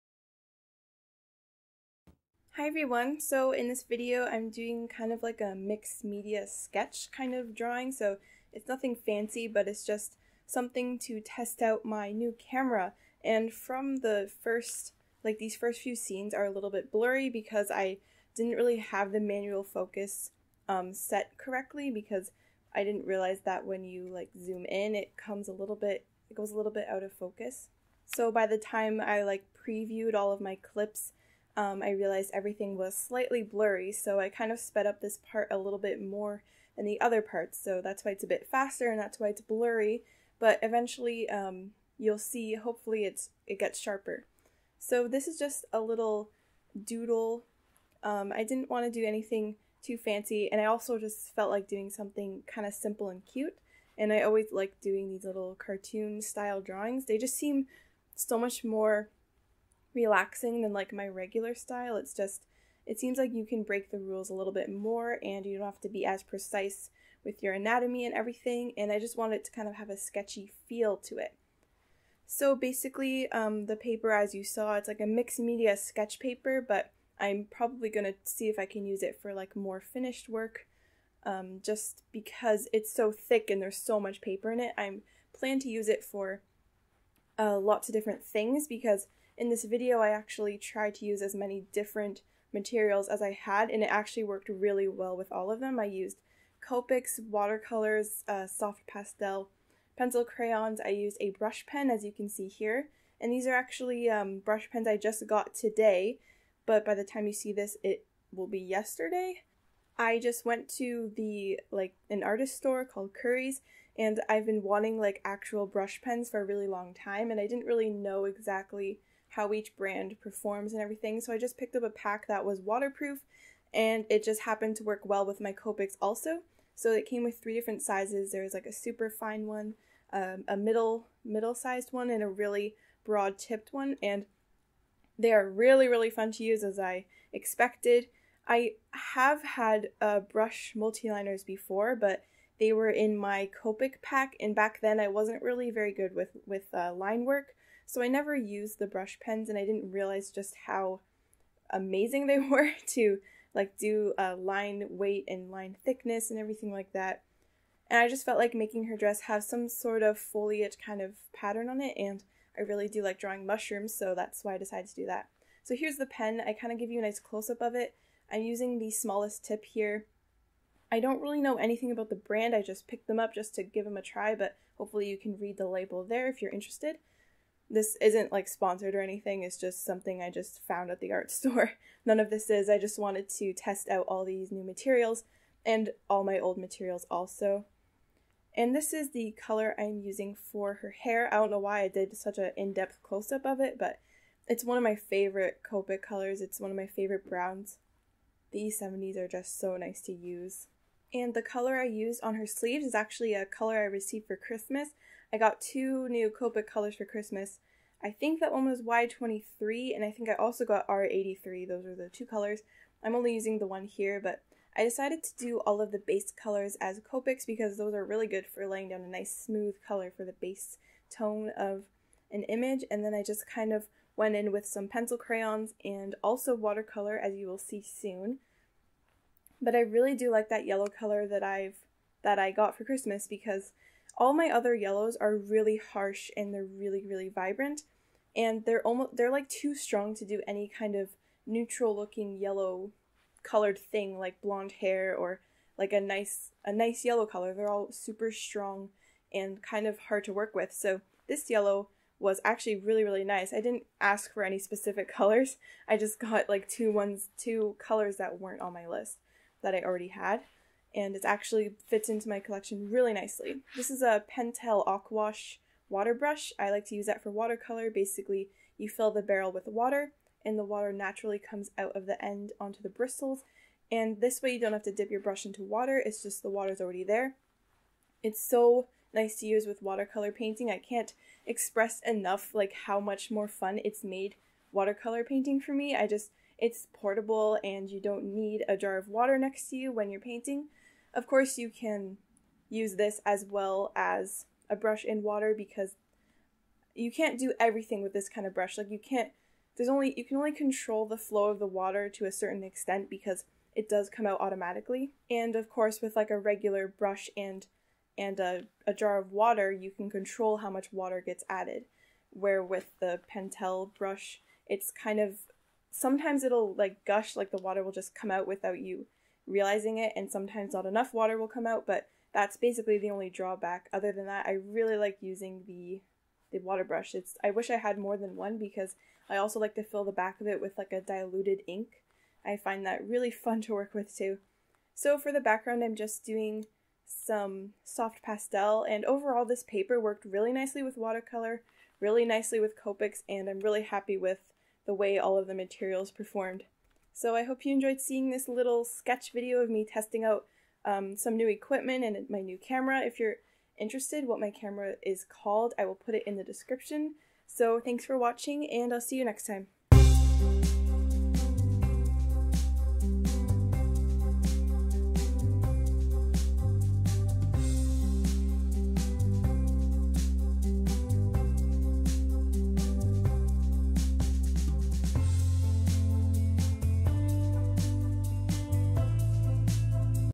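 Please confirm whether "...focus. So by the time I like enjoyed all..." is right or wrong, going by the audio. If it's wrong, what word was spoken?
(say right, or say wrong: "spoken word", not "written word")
wrong: "previewed", not "enjoyed".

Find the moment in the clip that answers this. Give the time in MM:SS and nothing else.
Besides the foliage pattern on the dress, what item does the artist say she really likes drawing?
02:43.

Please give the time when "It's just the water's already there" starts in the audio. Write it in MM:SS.
04:36.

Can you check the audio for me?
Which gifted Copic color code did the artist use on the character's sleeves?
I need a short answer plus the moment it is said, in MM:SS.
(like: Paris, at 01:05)
Y23, at 03:28.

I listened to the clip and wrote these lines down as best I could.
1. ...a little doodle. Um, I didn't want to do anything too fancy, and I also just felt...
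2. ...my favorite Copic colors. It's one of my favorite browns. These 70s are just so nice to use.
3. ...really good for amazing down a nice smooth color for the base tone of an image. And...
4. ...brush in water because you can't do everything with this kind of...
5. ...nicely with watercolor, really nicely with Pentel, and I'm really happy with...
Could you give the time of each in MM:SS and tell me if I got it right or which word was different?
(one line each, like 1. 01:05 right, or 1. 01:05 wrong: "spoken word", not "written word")
1. 00:45 right
2. 03:14 right
3. 03:38 wrong: "laying", not "amazing"
4. 04:54 right
5. 05:40 wrong: "Copics", not "Pentel".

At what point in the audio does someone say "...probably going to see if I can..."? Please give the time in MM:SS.
01:17.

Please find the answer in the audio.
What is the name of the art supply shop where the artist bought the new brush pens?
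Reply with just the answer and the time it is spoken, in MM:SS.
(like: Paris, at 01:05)
Curry's, at 01:53.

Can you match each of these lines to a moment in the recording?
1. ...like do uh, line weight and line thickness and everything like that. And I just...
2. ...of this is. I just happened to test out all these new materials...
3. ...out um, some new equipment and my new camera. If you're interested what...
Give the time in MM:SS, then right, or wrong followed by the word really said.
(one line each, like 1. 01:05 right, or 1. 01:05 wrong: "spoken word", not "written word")
1. 02:33 right
2. 03:02 wrong: "wanted", not "happened"
3. 05:50 right.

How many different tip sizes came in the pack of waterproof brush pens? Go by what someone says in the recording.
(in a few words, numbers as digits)
3.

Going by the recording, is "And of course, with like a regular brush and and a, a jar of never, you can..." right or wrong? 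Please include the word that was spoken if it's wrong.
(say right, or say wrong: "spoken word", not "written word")
wrong: "water", not "never".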